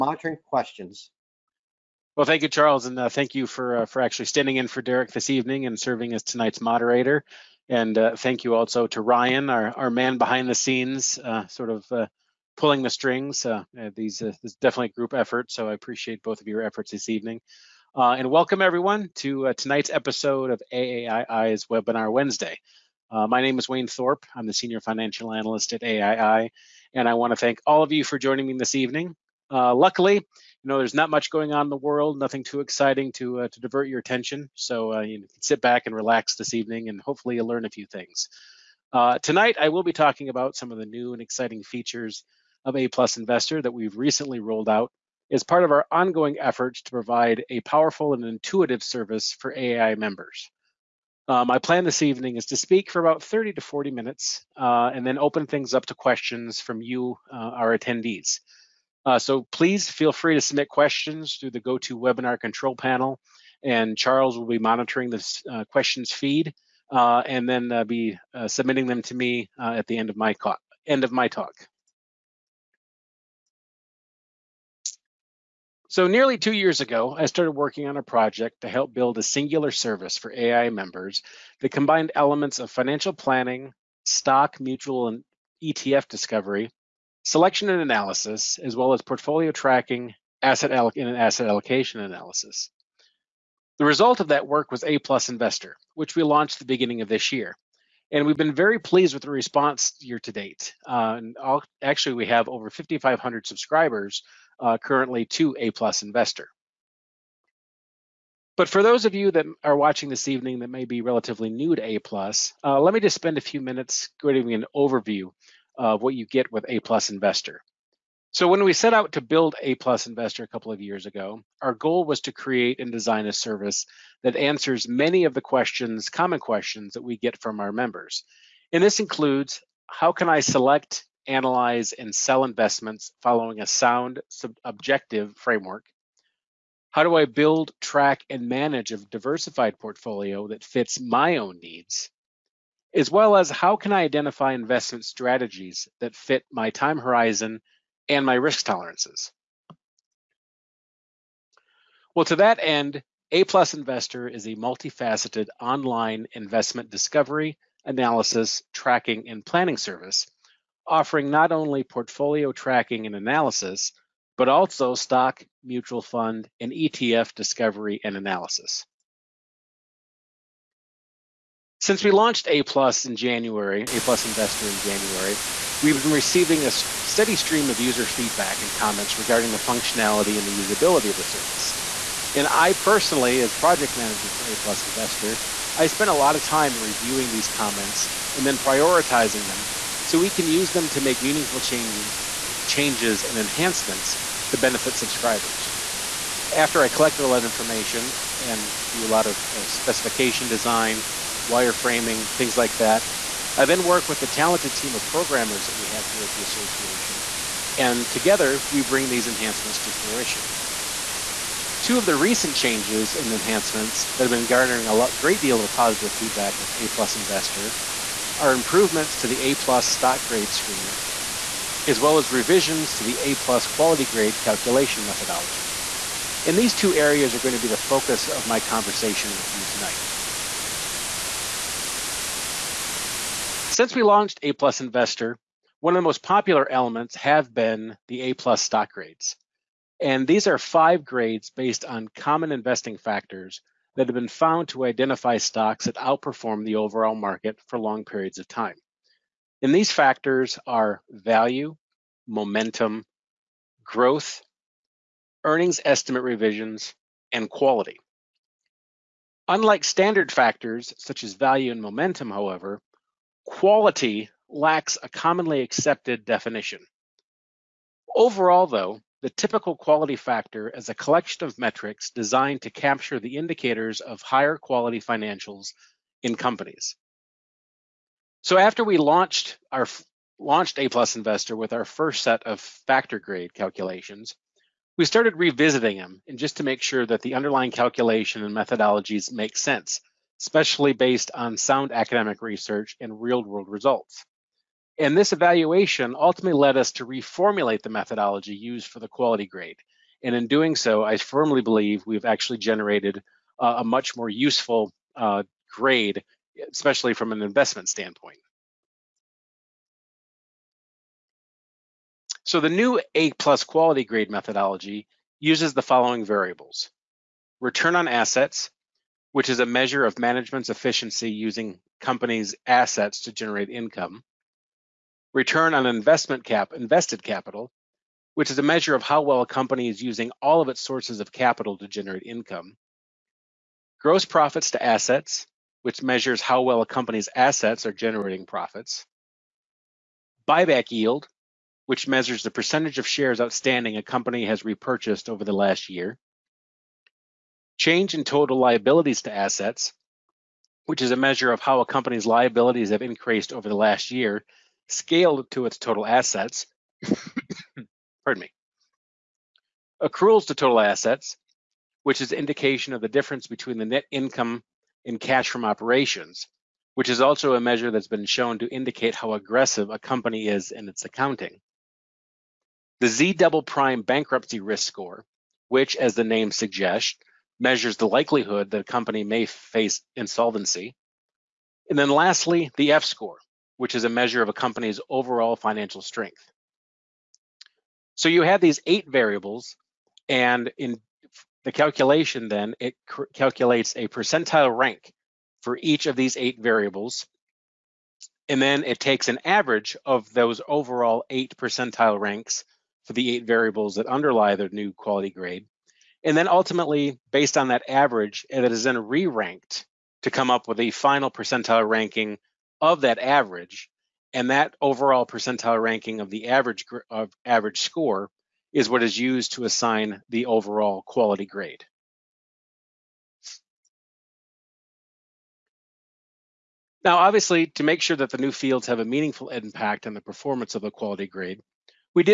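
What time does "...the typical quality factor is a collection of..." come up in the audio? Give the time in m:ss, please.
4:29.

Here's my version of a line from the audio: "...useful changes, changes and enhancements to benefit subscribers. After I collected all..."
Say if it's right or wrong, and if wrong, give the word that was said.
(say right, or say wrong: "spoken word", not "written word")
wrong: "meaningful", not "useful".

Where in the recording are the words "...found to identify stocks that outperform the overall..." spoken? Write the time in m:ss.
4:04.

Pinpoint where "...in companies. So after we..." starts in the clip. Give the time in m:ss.
4:36.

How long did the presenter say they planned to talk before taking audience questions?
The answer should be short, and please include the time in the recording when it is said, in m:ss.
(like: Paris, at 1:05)
30 to 40 minutes, at 0:53.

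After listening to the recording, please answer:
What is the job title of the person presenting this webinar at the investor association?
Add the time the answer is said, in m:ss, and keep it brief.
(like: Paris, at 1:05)
Senior financial analyst, at 0:24.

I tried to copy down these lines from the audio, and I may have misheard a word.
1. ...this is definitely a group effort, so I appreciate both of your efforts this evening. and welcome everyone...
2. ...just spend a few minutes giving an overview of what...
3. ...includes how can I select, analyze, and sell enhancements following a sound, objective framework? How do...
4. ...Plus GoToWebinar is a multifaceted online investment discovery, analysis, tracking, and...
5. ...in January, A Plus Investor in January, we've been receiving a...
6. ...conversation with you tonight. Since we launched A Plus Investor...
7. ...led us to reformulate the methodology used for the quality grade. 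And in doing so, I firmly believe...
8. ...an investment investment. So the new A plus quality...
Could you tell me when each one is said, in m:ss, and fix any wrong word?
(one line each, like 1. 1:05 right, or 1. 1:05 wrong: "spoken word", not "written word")
1. 0:14 right
2. 1:52 right
3. 2:08 wrong: "investments", not "enhancements"
4. 2:33 wrong: "Investor", not "GoToWebinar"
5. 2:53 right
6. 3:48 right
7. 4:56 right
8. 5:07 wrong: "standpoint", not "investment".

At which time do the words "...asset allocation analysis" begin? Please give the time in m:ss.
1:31.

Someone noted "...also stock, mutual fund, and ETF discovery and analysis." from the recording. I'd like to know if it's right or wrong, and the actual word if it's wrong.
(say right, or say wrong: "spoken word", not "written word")
right.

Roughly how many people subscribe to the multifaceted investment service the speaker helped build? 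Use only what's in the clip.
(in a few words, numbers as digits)
5,500.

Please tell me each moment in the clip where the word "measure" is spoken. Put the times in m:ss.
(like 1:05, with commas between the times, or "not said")
5:19, 5:28, 5:35, 5:42, 5:51, 6:07, 6:17, 6:24.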